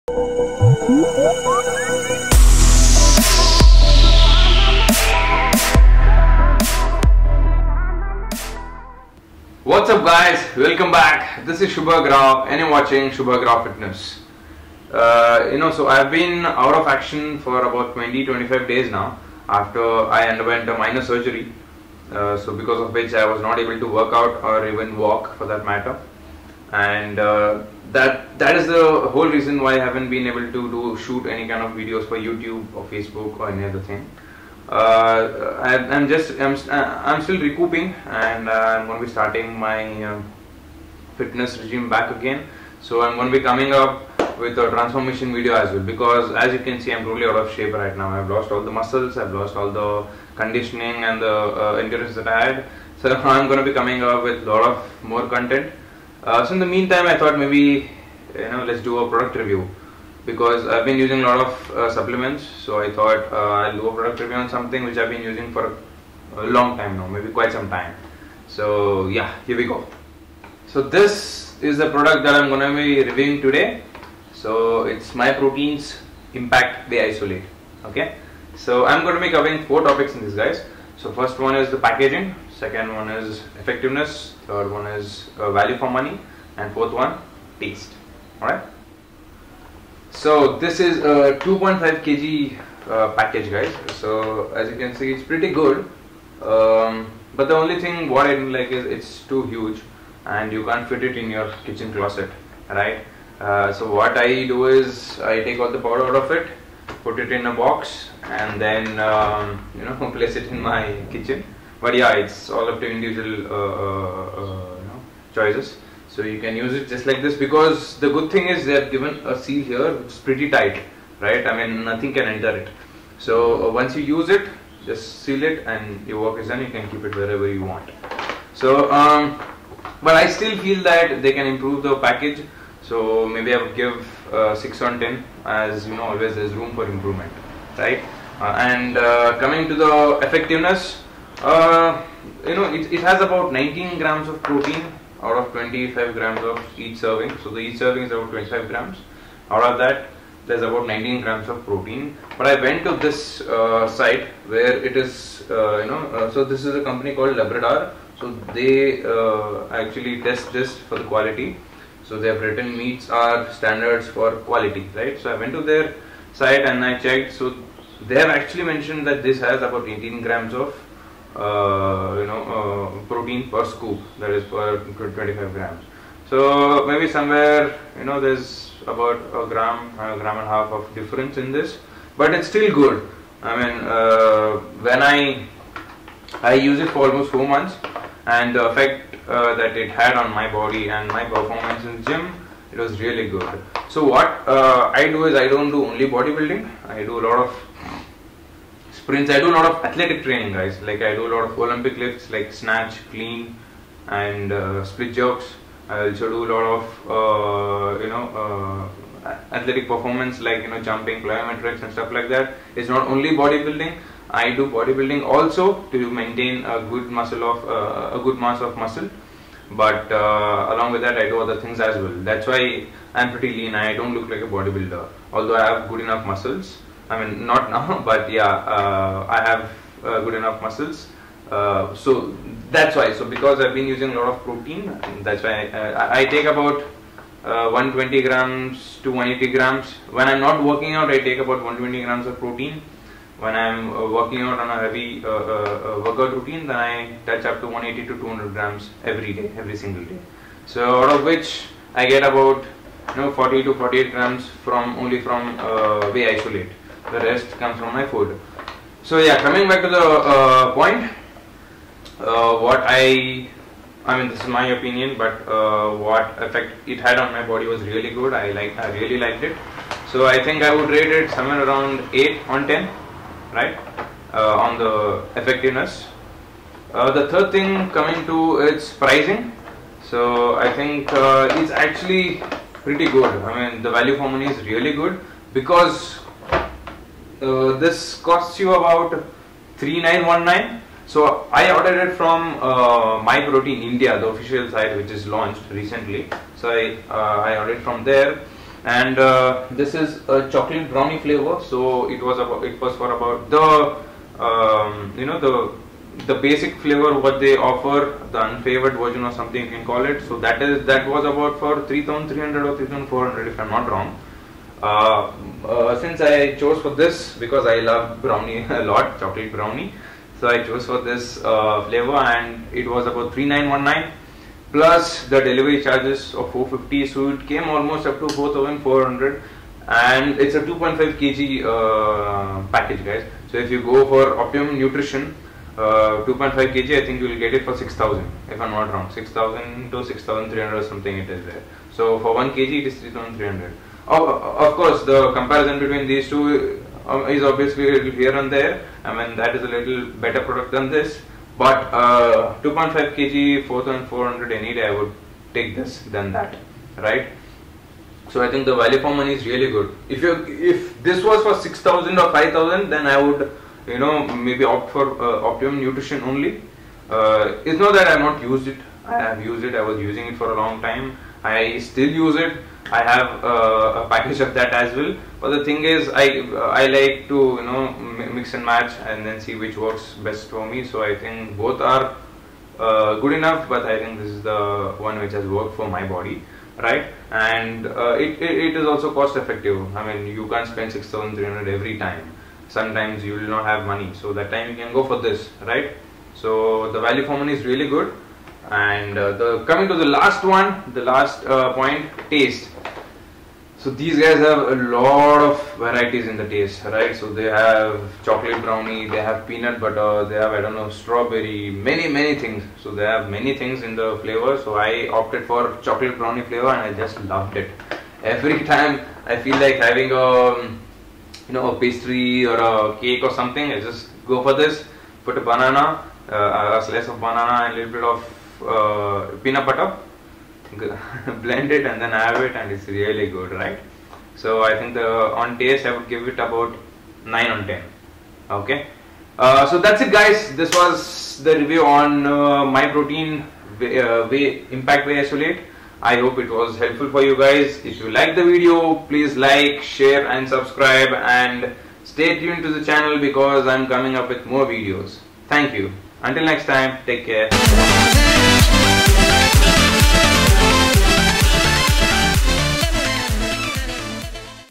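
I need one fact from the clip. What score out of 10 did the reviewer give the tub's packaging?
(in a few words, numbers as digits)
6.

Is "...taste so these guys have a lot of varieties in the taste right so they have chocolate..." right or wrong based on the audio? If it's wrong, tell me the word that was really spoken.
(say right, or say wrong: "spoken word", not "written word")
right.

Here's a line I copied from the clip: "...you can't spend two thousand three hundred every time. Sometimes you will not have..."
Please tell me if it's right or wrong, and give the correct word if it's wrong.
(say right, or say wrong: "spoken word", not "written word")
wrong: "six", not "two".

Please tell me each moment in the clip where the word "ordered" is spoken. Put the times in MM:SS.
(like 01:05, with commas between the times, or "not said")
04:51, 04:57.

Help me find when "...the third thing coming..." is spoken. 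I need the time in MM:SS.
04:37.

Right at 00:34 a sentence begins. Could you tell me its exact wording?
Uh, I, am just I'm uh, I'm still recouping and uh, I'm going to be starting my uh, fitness regime back again.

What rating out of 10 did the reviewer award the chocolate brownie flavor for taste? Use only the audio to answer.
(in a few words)
9.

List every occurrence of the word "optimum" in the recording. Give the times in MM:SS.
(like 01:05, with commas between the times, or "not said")
05:34, 06:05.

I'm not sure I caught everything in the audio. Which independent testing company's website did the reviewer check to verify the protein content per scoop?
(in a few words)
Labdoor.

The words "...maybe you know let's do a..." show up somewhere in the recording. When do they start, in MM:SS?
00:57.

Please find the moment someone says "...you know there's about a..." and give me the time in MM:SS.
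02:57.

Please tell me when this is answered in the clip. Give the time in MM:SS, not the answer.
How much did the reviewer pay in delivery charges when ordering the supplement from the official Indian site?
05:26.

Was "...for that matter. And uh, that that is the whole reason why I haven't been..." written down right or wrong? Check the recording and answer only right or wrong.
right.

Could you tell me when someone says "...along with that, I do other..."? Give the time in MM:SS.
03:40.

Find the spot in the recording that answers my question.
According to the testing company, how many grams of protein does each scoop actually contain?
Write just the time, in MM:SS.
02:49.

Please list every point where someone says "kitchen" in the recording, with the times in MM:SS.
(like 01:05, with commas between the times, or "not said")
01:41, 01:51.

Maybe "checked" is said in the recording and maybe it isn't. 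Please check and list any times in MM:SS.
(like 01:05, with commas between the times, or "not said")
02:46.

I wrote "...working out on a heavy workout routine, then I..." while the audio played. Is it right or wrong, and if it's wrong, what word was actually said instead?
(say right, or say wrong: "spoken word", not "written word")
right.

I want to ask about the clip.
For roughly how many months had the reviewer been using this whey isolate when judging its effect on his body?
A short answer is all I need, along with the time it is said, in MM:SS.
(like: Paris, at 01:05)
4, at 03:07.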